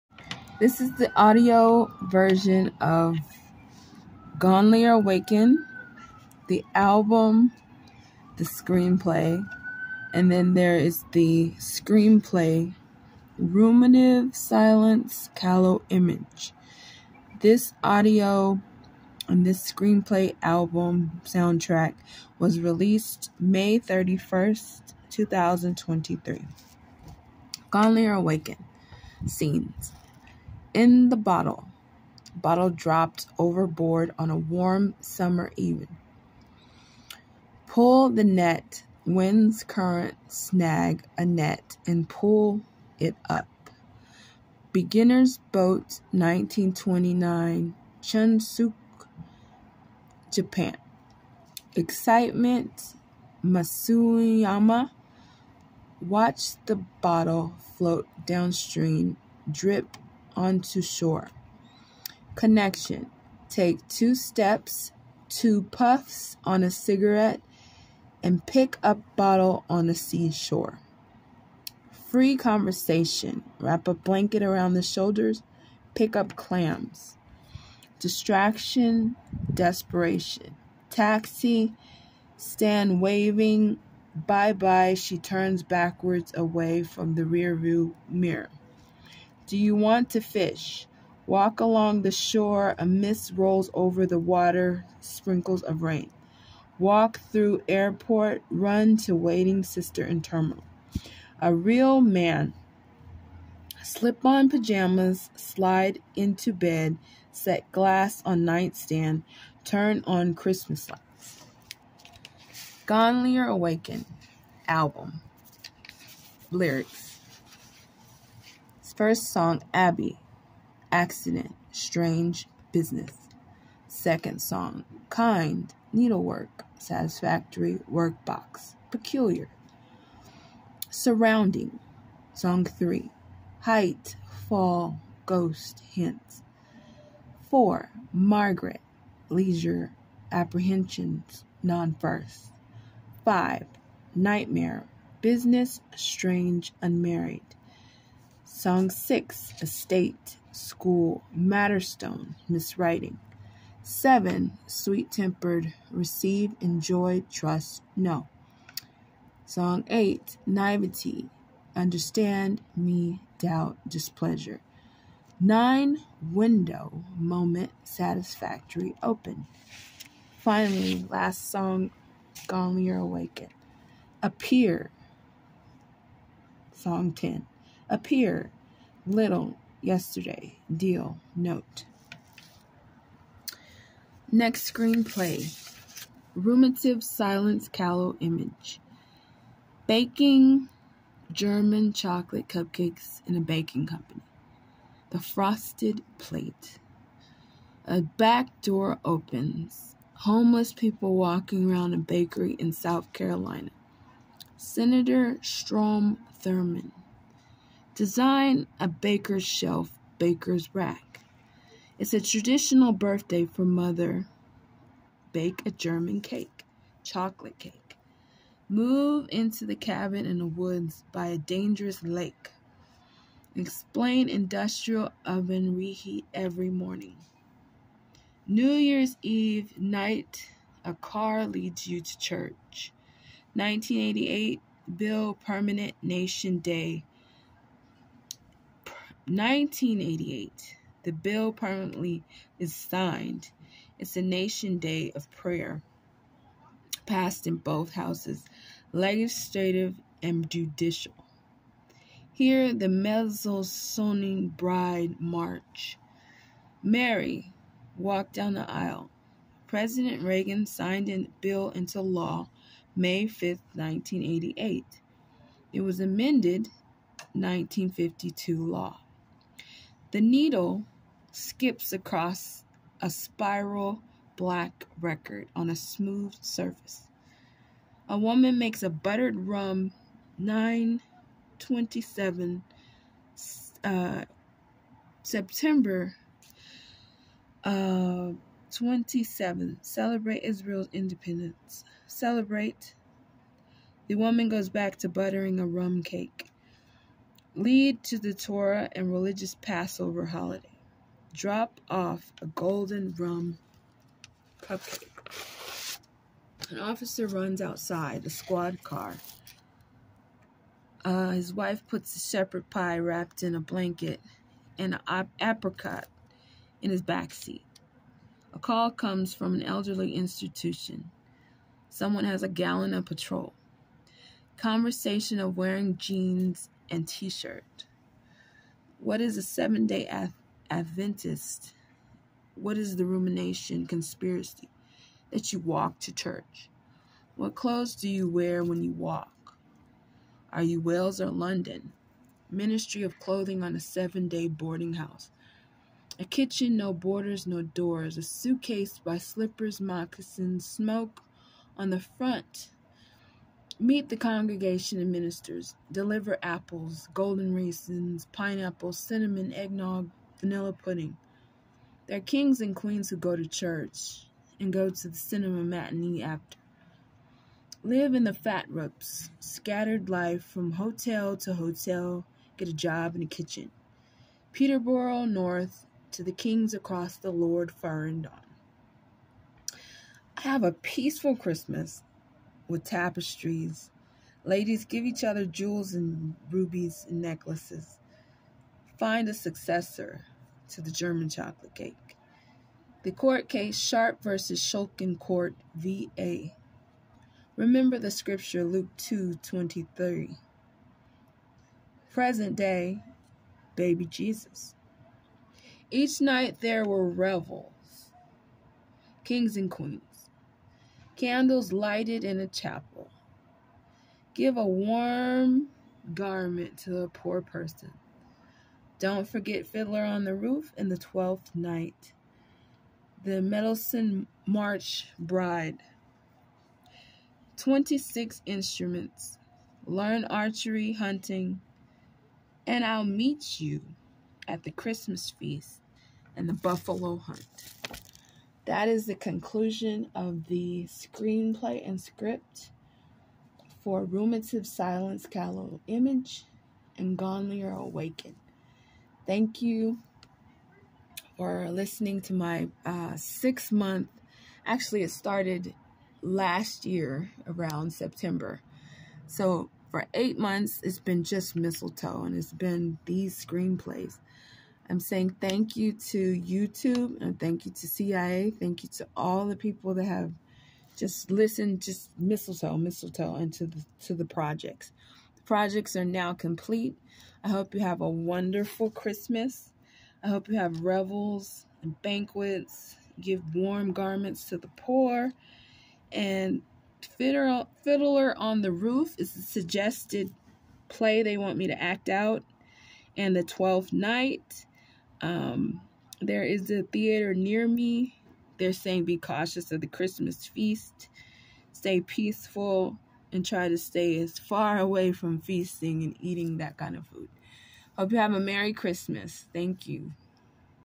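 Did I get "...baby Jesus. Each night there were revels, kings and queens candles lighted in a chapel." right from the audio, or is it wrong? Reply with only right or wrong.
right.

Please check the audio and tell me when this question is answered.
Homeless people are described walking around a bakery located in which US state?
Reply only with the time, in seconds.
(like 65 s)
202 s.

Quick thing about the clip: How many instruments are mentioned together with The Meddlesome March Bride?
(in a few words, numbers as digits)
26.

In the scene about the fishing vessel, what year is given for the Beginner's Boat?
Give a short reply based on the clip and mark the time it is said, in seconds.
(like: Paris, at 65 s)
1929, at 46 s.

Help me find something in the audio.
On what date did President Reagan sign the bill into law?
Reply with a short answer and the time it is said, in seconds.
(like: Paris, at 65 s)
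May 5, 1988, at 262 s.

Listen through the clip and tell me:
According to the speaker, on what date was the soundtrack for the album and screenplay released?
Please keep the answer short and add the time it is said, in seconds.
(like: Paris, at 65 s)
May 31, 2023, at 23 s.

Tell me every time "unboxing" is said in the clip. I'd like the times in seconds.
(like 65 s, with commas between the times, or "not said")
not said.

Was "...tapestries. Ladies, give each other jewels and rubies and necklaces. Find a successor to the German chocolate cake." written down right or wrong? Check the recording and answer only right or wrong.
right.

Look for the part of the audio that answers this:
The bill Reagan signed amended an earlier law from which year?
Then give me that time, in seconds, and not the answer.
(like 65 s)
267 s.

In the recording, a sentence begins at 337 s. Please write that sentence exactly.
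What clothes do you wear when you walk?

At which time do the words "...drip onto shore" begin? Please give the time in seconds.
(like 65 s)
59 s.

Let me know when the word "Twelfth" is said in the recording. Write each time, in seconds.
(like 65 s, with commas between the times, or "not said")
420 s, 493 s.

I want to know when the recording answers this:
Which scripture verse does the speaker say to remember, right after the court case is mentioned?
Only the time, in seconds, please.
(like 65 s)
398 s.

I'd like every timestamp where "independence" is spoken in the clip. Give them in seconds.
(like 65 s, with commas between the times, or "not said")
290 s.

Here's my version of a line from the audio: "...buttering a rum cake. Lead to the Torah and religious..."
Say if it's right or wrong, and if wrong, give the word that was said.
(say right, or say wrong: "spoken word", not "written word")
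right.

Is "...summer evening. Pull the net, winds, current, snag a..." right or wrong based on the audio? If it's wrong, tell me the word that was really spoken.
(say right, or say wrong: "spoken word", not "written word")
right.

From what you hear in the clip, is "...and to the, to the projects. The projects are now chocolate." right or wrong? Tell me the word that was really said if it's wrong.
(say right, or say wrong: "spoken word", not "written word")
wrong: "complete", not "chocolate".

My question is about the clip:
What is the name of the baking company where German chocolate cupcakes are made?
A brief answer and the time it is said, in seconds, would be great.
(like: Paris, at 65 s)
The Frosted Plate, at 195 s.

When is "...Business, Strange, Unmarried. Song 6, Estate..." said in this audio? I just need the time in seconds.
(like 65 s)
145 s.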